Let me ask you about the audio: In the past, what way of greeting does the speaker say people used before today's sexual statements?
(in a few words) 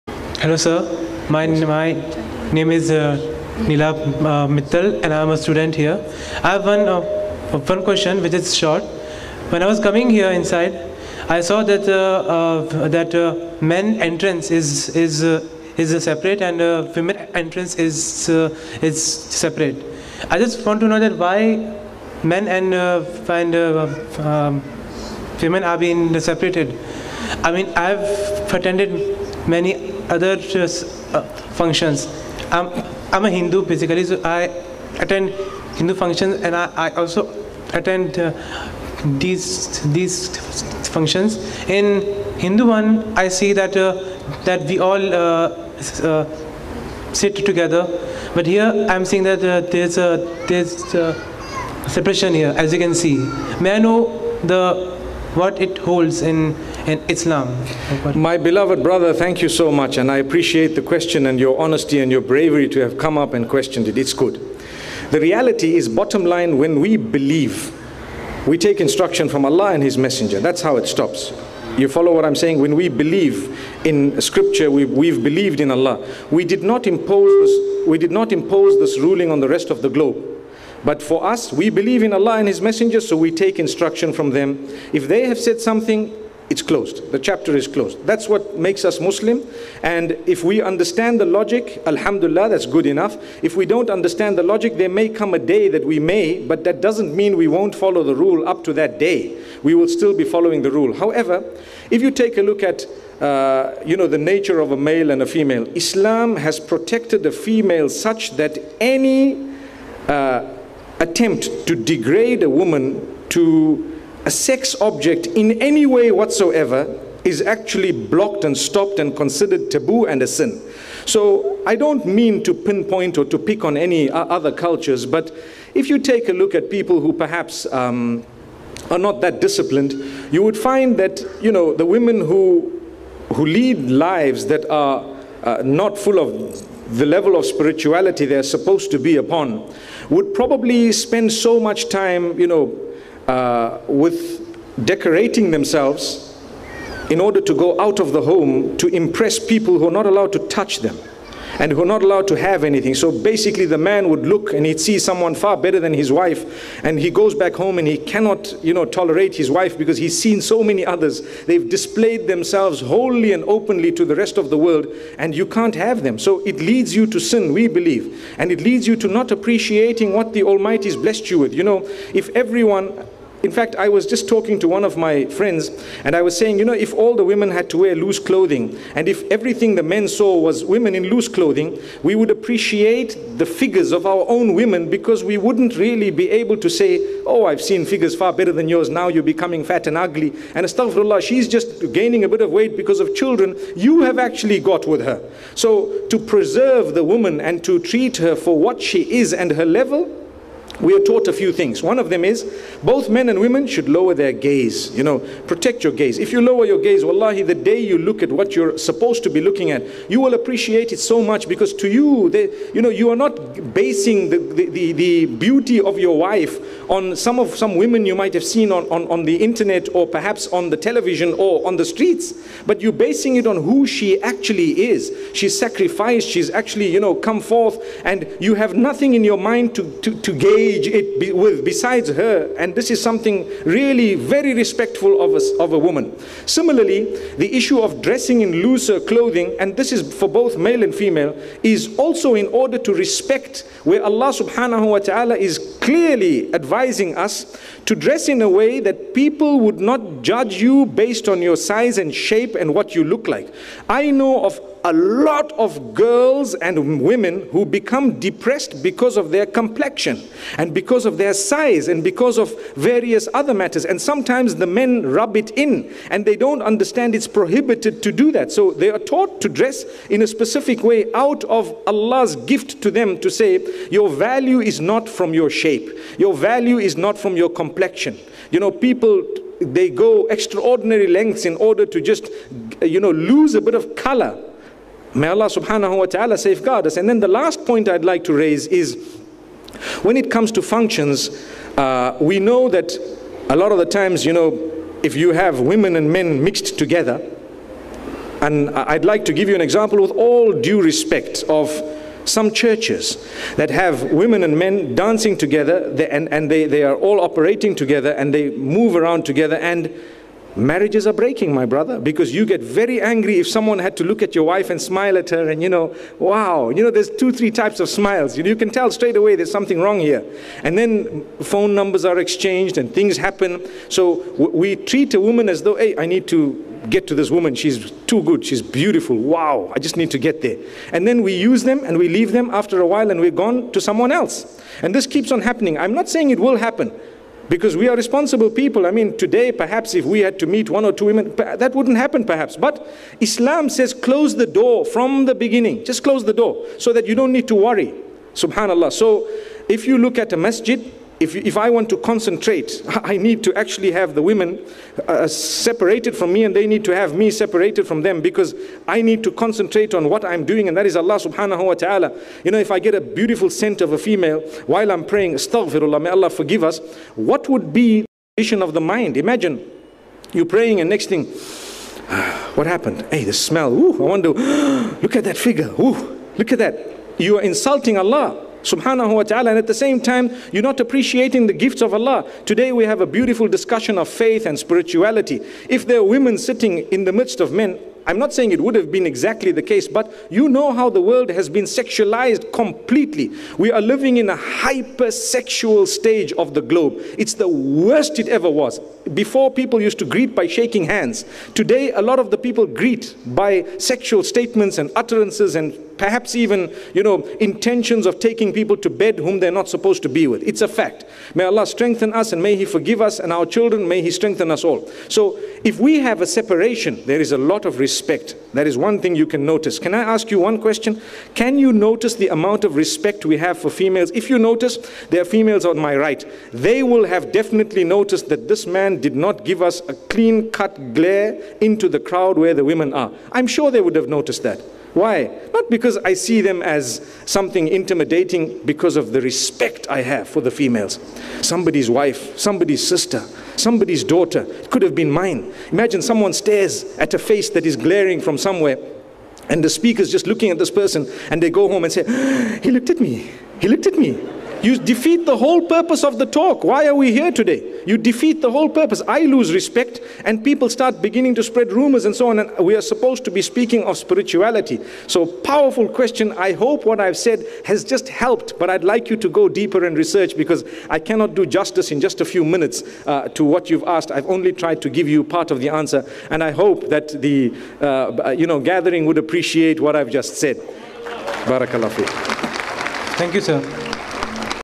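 Shaking hands.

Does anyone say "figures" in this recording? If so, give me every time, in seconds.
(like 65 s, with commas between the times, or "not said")
183 s, 187 s, 375 s.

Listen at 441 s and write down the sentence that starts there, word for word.
Somebody's wife, somebody's sister, somebody's daughter.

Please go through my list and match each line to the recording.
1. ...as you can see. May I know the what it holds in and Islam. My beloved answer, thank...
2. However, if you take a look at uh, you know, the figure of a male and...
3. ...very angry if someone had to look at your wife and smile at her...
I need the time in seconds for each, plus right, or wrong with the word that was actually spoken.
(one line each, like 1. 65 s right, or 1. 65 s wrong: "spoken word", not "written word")
1. 52 s wrong: "brother", not "answer"
2. 100 s wrong: "nature", not "figure"
3. 312 s right.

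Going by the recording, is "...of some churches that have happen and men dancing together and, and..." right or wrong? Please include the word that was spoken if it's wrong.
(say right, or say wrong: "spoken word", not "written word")
wrong: "women", not "happen".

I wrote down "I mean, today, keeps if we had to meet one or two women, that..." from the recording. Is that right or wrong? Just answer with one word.
wrong.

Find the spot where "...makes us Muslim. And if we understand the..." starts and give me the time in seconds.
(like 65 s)
88 s.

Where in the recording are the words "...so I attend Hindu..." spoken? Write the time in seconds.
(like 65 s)
34 s.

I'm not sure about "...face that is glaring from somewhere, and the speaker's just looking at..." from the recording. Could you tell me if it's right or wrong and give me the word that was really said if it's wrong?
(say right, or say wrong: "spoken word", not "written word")
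right.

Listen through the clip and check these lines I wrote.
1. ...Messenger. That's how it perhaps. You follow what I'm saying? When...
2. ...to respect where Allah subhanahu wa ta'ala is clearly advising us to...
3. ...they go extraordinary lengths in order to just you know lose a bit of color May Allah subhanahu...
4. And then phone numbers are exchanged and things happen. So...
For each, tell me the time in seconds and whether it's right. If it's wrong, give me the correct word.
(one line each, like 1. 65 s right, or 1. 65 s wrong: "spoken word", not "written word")
1. 69 s wrong: "stops", not "perhaps"
2. 242 s right
3. 279 s right
4. 320 s right.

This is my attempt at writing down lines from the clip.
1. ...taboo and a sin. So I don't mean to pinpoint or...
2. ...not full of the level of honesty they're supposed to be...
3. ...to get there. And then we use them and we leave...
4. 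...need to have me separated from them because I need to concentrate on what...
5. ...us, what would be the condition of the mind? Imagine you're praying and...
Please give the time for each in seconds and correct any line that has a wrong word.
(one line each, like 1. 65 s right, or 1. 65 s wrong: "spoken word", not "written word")
1. 119 s right
2. 135 s wrong: "spirituality", not "honesty"
3. 330 s right
4. 356 s right
5. 366 s right.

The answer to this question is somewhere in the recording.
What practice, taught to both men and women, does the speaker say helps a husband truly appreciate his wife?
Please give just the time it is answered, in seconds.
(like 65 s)
203 s.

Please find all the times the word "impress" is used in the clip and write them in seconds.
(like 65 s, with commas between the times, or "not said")
148 s.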